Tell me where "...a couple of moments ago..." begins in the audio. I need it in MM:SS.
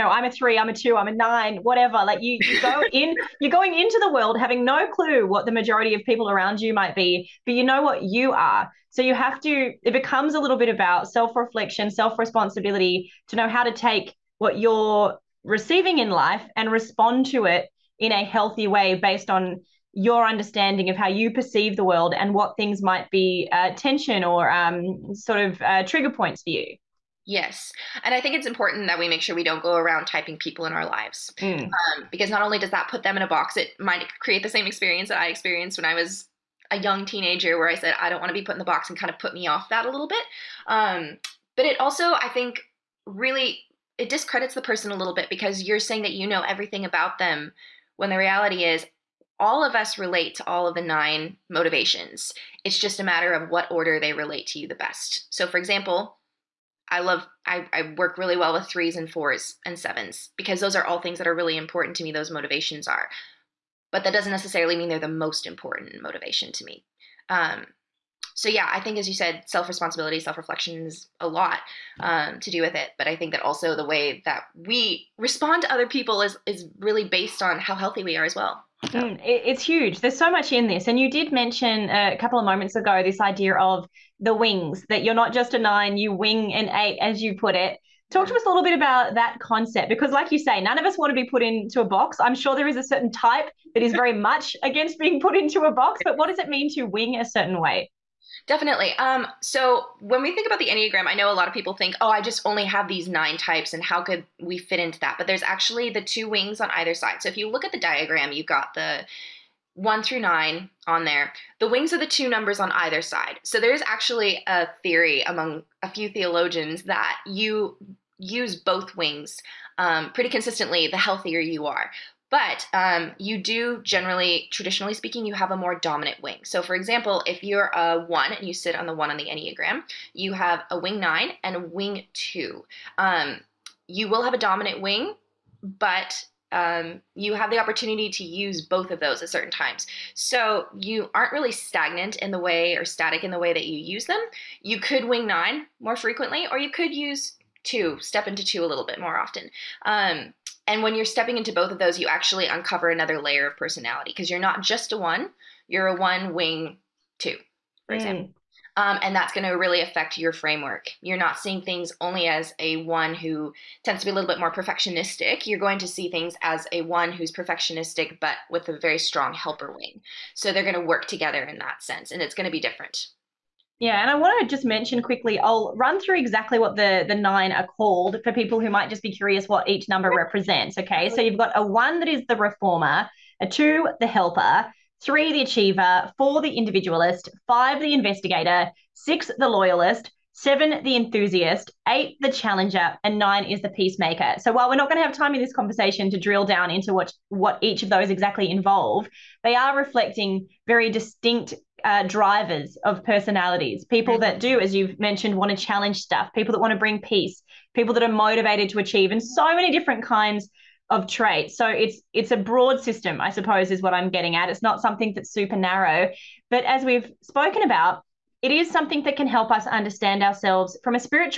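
01:22.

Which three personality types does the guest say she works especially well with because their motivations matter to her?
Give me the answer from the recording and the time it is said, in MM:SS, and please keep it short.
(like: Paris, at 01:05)
3, 4 and 7, at 00:58.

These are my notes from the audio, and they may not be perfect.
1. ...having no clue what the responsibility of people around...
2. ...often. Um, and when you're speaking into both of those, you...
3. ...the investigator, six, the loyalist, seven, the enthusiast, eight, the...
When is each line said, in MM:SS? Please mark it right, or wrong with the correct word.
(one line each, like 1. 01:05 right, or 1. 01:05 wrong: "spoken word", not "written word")
1. 00:04 wrong: "majority", not "responsibility"
2. 02:29 wrong: "stepping", not "speaking"
3. 03:07 right.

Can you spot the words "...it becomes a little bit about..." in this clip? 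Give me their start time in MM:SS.
00:09.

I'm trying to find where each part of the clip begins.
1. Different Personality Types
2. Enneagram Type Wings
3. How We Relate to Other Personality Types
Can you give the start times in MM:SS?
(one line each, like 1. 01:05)
1. 02:53
2. 01:27
3. 00:37.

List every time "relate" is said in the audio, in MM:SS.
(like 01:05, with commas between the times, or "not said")
00:49, 00:54.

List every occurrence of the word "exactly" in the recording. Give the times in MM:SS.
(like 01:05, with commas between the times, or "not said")
02:56, 03:18.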